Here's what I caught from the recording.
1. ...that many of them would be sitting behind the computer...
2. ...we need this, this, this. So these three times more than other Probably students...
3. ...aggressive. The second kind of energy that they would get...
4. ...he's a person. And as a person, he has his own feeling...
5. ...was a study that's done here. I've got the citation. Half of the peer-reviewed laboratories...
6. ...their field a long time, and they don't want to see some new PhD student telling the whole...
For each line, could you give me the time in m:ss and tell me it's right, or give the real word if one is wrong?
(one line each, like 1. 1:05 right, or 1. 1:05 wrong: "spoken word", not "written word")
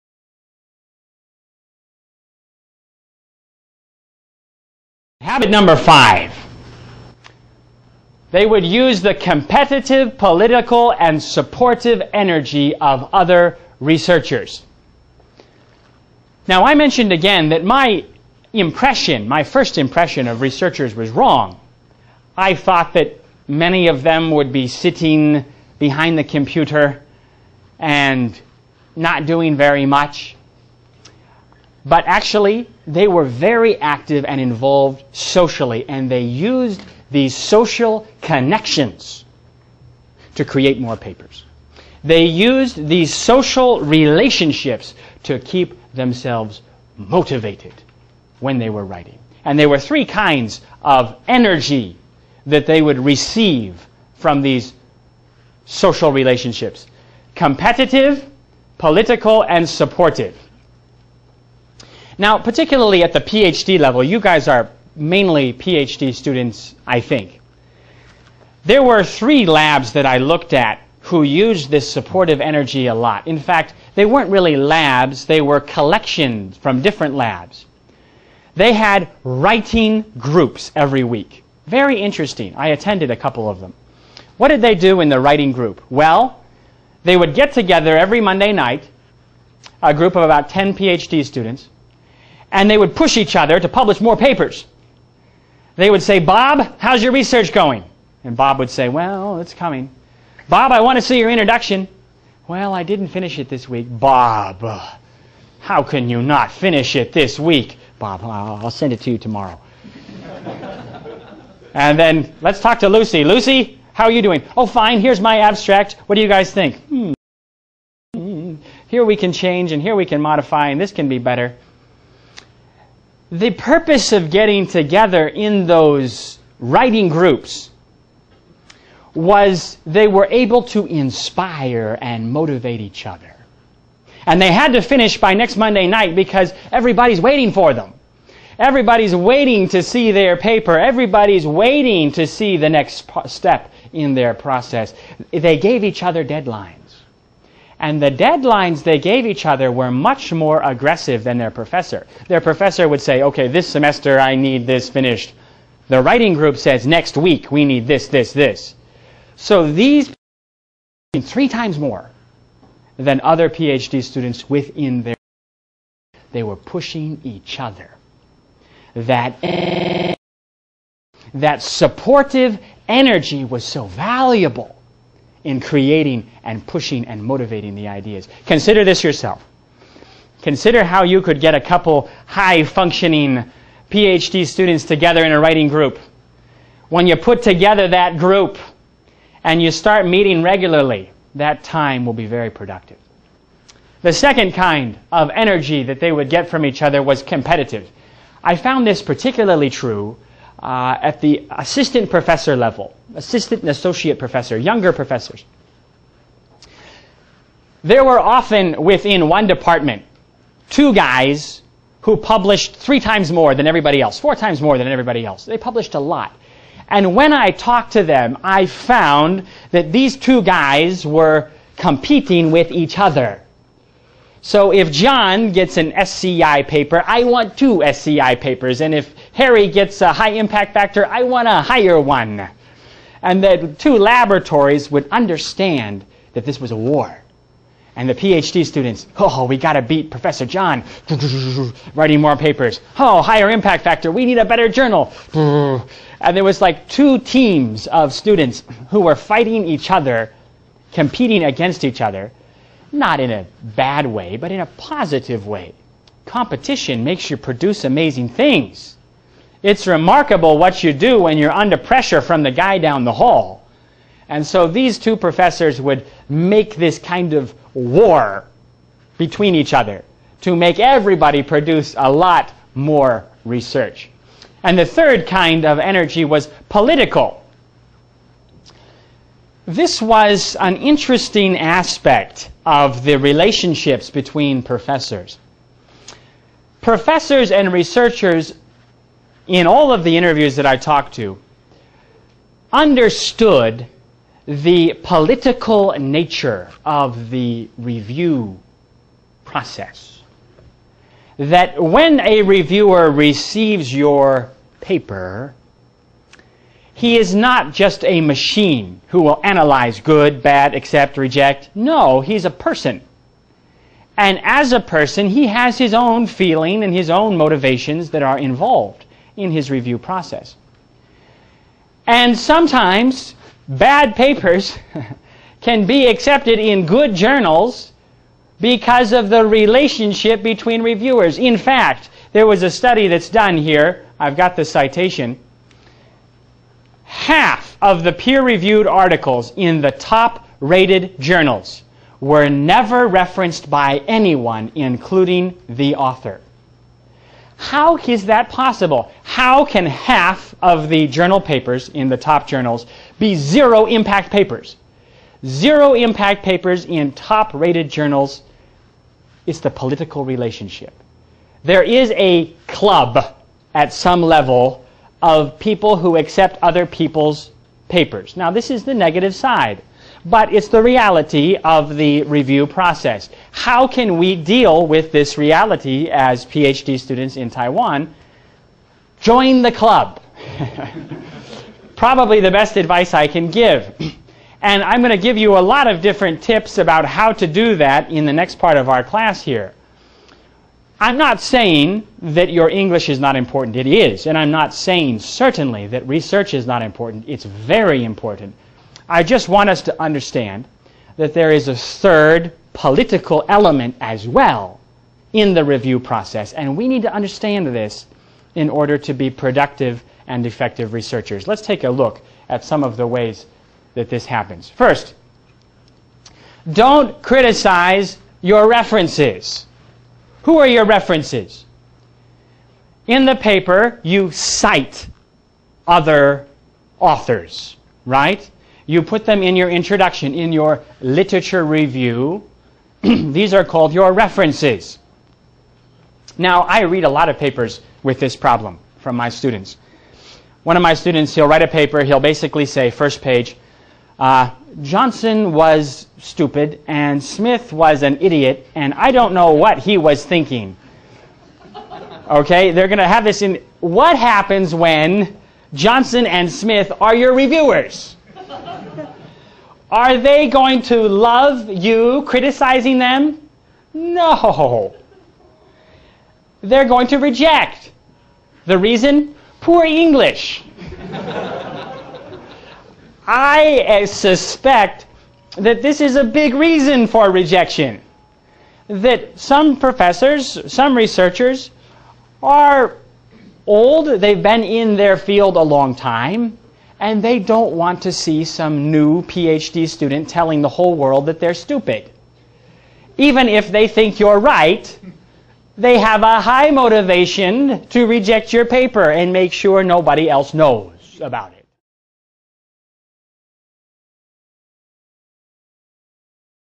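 1. 0:22 right
2. 2:37 wrong: "PhD", not "Probably"
3. 3:12 wrong: "productive", not "aggressive"
4. 5:12 right
5. 5:32 wrong: "articles", not "laboratories"
6. 8:04 right.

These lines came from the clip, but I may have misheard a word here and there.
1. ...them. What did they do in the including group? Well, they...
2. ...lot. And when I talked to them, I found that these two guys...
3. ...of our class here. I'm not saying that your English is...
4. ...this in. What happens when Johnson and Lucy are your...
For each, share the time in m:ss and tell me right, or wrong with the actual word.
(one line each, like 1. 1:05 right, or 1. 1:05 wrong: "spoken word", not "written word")
1. 1:23 wrong: "writing", not "including"
2. 3:35 right
3. 6:28 right
4. 7:33 wrong: "Smith", not "Lucy".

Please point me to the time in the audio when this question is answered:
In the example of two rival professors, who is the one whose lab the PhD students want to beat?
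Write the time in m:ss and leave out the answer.
4:00.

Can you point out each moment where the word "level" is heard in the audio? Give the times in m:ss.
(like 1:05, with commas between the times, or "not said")
1:03, 3:22, 6:04.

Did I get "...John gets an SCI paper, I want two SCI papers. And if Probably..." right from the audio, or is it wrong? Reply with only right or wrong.
wrong.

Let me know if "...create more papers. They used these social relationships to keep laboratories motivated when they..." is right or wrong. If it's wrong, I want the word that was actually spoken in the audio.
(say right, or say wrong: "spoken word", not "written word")
wrong: "themselves", not "laboratories".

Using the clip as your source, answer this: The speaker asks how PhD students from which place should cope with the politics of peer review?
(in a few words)
Taiwan.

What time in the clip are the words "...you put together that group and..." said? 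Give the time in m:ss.
3:07.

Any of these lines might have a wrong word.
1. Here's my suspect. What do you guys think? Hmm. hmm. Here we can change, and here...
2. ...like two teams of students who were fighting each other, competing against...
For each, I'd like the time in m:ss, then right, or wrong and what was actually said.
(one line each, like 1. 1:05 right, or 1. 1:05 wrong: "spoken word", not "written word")
1. 1:54 wrong: "abstract", not "suspect"
2. 4:06 right.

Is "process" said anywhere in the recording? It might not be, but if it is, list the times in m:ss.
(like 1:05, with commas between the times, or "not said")
2:24, 4:59, 5:19, 6:12, 6:45.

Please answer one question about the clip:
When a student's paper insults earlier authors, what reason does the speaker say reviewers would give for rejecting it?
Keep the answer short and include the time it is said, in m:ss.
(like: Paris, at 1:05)
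Poor English, at 7:49.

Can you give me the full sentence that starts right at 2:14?
And they had to finish by next Monday night because everybody's waiting for them.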